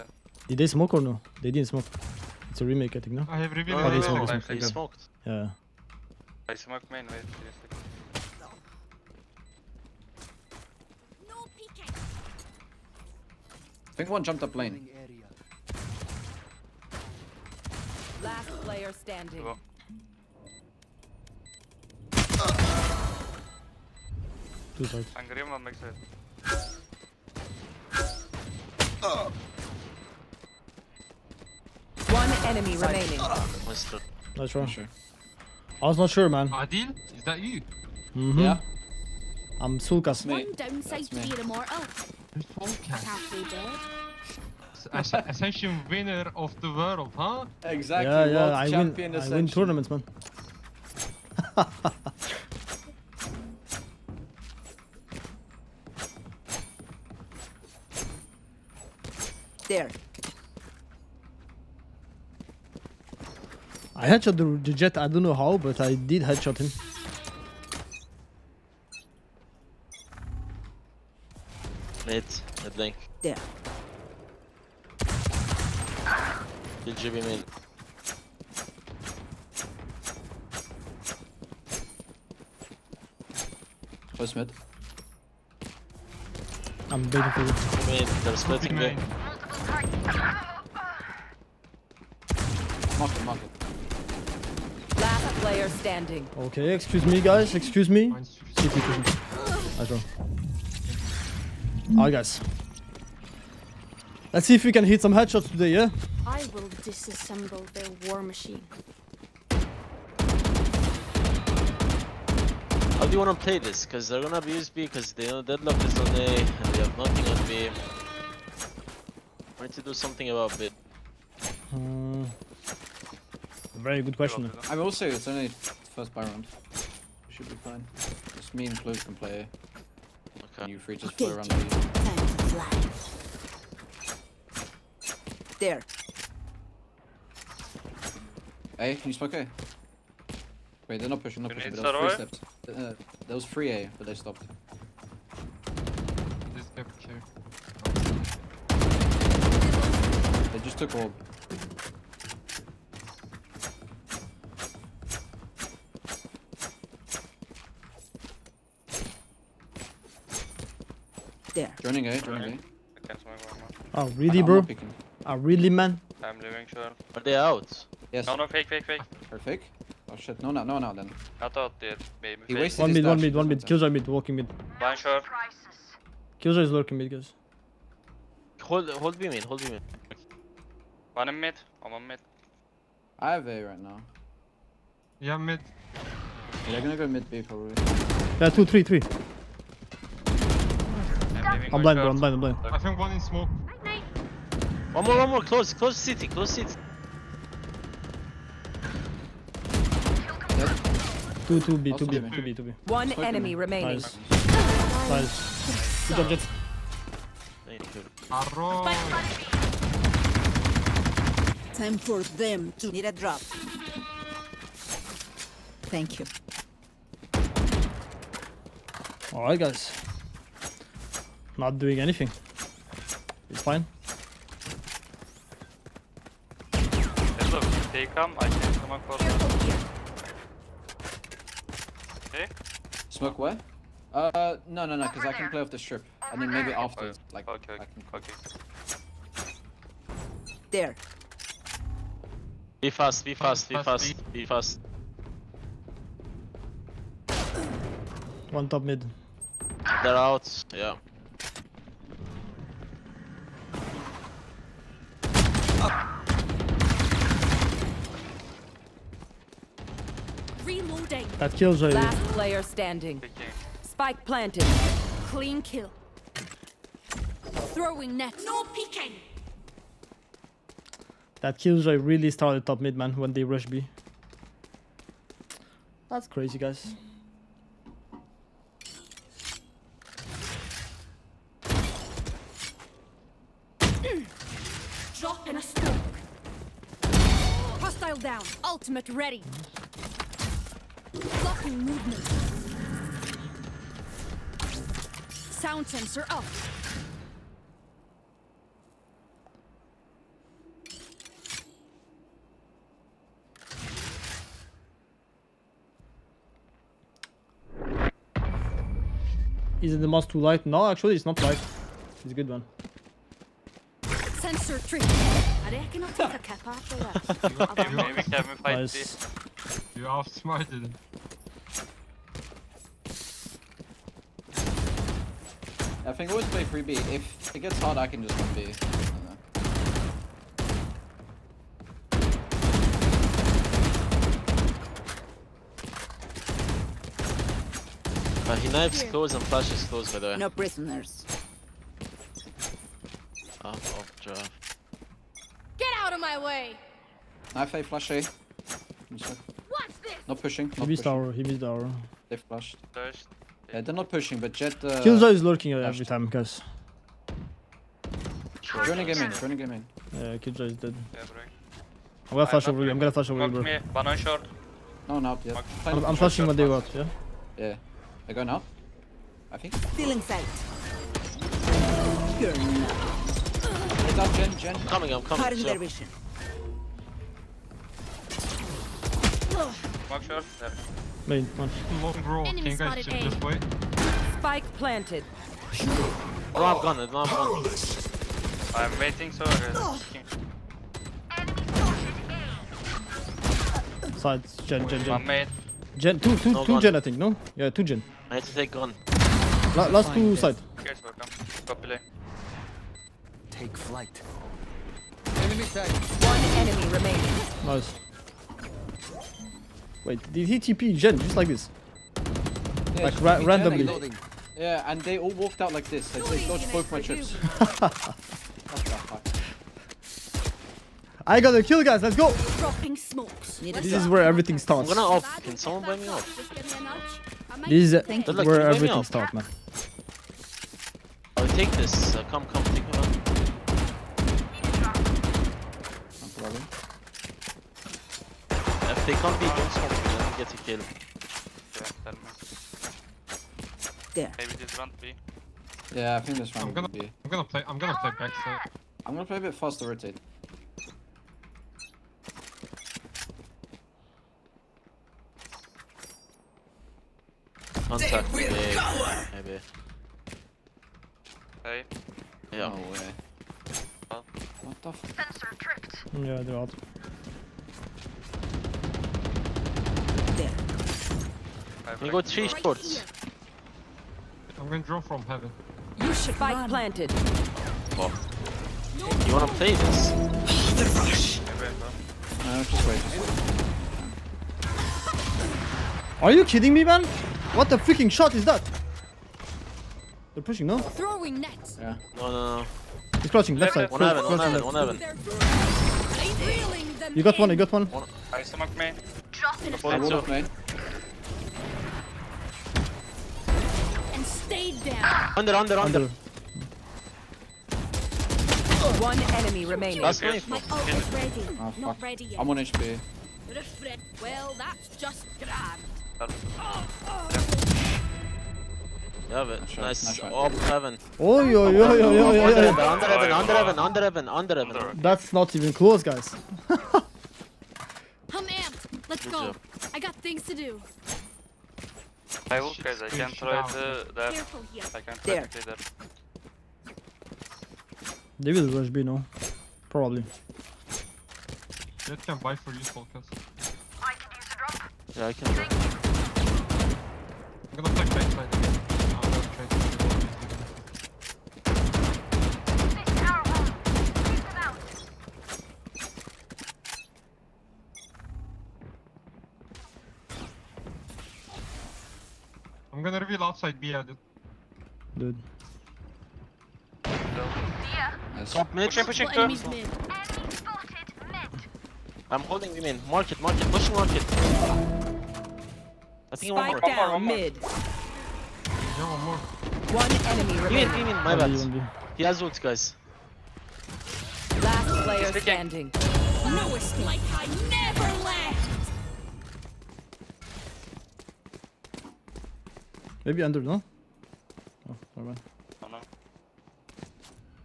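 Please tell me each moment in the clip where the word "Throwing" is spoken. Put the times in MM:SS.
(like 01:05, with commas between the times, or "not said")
04:27, 08:10.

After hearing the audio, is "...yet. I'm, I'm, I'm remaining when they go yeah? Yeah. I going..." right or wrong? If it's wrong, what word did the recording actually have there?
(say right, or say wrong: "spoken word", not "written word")
wrong: "flashing", not "remaining".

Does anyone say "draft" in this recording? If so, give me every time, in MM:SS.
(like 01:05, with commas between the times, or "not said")
05:44.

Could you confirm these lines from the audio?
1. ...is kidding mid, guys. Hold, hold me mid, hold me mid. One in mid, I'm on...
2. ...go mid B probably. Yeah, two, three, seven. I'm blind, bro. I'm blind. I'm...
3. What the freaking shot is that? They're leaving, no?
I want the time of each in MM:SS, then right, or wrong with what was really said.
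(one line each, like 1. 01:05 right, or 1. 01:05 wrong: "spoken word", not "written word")
1. 02:56 wrong: "lurking", not "kidding"
2. 03:06 wrong: "three", not "seven"
3. 08:07 wrong: "pushing", not "leaving".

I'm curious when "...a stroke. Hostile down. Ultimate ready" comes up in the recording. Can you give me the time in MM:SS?
04:45.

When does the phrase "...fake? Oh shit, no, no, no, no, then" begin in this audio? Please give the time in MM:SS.
02:49.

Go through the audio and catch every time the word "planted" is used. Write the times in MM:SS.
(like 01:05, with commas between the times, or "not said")
04:24, 06:24, 07:56.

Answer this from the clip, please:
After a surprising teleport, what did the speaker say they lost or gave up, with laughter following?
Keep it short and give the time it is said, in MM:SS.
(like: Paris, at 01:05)
both my chips, at 06:56.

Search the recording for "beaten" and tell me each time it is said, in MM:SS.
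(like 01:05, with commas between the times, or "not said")
not said.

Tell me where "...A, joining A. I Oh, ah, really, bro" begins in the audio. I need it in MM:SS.
02:42.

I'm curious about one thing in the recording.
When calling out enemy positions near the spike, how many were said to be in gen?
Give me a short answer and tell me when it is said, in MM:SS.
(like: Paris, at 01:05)
2, at 06:37.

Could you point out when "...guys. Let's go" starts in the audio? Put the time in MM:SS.
07:01.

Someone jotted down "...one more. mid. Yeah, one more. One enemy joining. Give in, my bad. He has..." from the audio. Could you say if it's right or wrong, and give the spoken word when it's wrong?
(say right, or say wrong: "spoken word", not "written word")
wrong: "remaining", not "joining".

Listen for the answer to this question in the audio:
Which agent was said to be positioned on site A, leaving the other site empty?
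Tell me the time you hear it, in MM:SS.
01:55.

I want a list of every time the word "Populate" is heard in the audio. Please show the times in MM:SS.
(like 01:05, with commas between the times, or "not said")
06:41.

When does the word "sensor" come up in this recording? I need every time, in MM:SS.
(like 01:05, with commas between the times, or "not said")
04:55, 05:14.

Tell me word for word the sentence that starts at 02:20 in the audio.
Wait, they're not pushing, not pushing, but there was three steps.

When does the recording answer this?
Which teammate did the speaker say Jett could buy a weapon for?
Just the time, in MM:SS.
09:02.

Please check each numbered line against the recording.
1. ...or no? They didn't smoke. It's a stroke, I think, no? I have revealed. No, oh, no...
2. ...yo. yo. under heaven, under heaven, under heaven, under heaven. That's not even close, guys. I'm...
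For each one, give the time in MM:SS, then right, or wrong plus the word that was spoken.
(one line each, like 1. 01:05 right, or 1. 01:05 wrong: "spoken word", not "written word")
1. 00:00 wrong: "remake", not "stroke"
2. 08:42 right.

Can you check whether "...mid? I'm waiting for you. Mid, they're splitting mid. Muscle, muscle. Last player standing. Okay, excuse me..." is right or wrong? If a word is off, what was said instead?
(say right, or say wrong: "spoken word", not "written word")
right.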